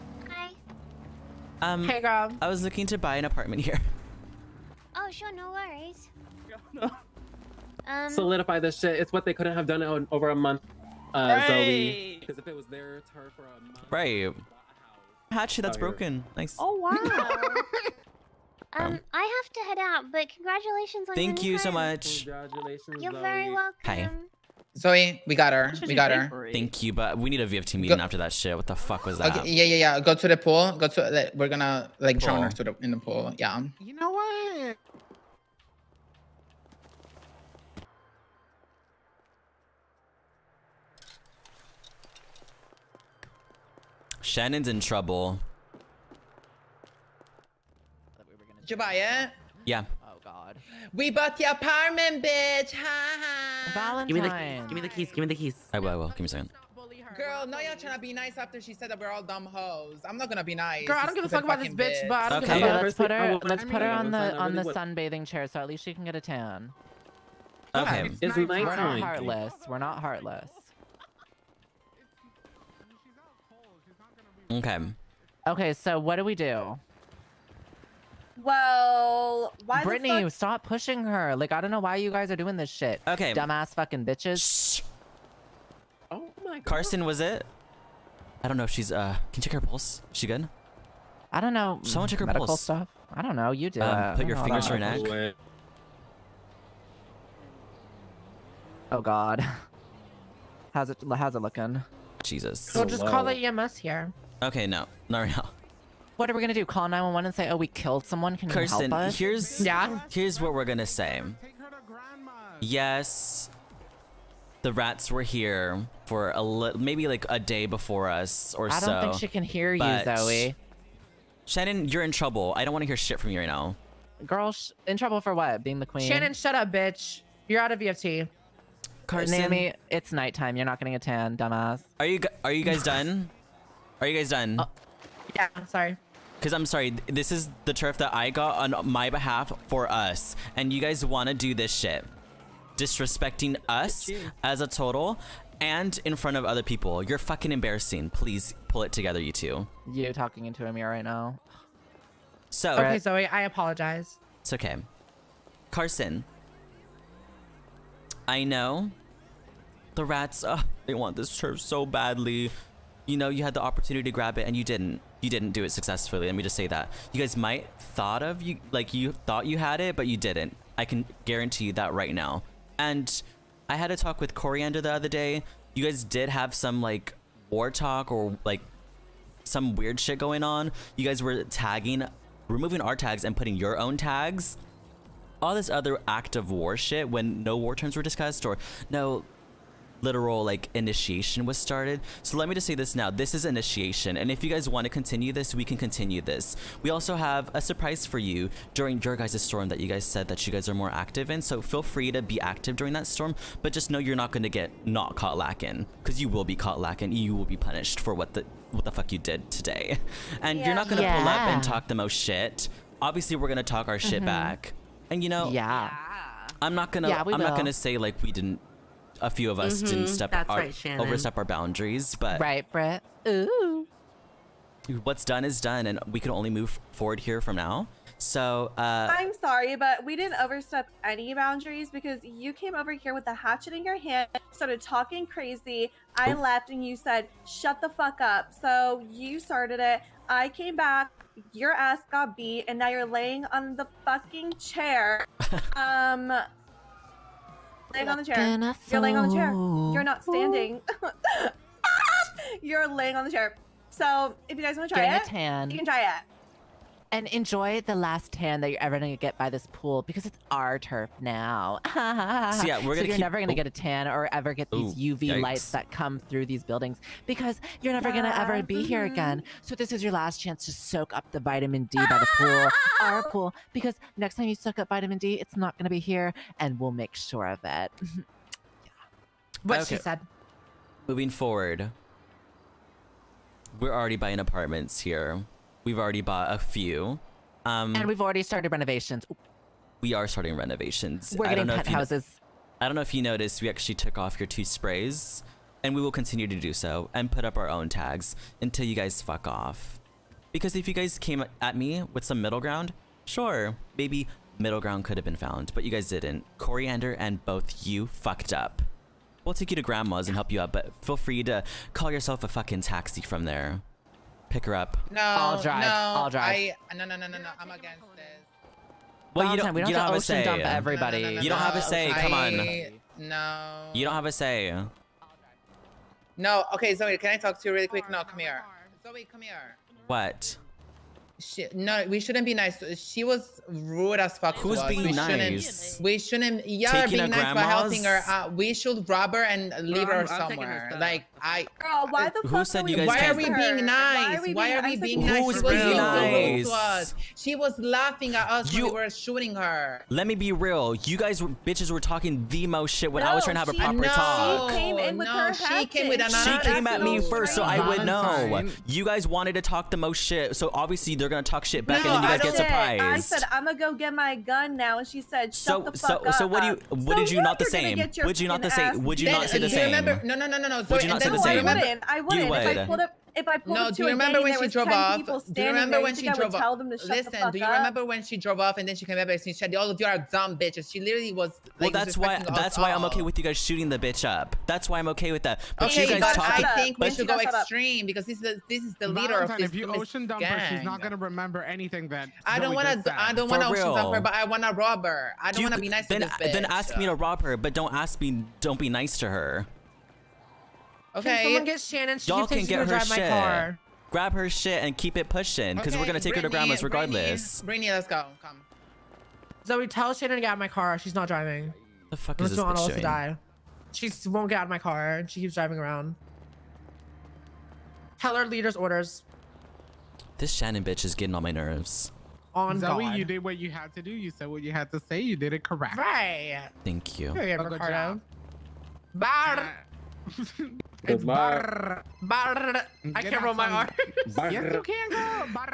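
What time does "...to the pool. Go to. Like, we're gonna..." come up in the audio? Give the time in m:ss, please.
0:30.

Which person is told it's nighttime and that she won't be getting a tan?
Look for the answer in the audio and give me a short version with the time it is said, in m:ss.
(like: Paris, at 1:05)
Naomi, at 2:09.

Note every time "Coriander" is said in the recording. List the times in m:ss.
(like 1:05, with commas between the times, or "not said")
2:54, 5:06.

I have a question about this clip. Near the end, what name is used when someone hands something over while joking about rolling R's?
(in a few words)
Ricardo.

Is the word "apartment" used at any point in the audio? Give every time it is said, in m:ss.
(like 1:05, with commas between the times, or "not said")
0:03, 0:51, 4:44.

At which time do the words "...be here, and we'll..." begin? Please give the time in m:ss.
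4:35.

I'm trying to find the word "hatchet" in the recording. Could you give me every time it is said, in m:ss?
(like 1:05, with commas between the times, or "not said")
0:15, 3:53.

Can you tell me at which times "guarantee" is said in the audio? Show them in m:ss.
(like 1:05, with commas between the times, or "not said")
2:51.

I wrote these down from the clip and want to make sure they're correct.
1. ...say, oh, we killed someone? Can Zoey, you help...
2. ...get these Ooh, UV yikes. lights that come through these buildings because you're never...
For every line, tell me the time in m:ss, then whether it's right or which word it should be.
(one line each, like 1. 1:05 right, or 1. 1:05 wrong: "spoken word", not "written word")
1. 1:47 wrong: "Kirsten", not "Zoey"
2. 4:24 right.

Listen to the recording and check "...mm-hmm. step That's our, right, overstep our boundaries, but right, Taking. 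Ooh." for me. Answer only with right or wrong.
wrong.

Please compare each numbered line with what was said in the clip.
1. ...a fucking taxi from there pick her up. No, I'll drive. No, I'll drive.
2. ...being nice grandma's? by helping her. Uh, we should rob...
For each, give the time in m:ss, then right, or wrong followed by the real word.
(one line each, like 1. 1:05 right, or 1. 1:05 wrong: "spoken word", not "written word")
1. 5:12 right
2. 5:37 right.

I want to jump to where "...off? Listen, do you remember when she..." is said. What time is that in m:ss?
6:16.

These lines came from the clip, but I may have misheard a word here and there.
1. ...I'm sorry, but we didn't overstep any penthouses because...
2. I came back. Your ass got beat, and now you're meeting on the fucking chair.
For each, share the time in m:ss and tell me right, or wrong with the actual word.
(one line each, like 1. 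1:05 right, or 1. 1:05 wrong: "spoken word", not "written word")
1. 3:49 wrong: "boundaries", not "penthouses"
2. 4:00 wrong: "laying", not "meeting".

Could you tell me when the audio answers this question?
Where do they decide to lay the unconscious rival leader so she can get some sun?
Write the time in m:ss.
1:04.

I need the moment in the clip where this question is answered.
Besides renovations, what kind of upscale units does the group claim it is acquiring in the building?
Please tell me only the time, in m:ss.
4:51.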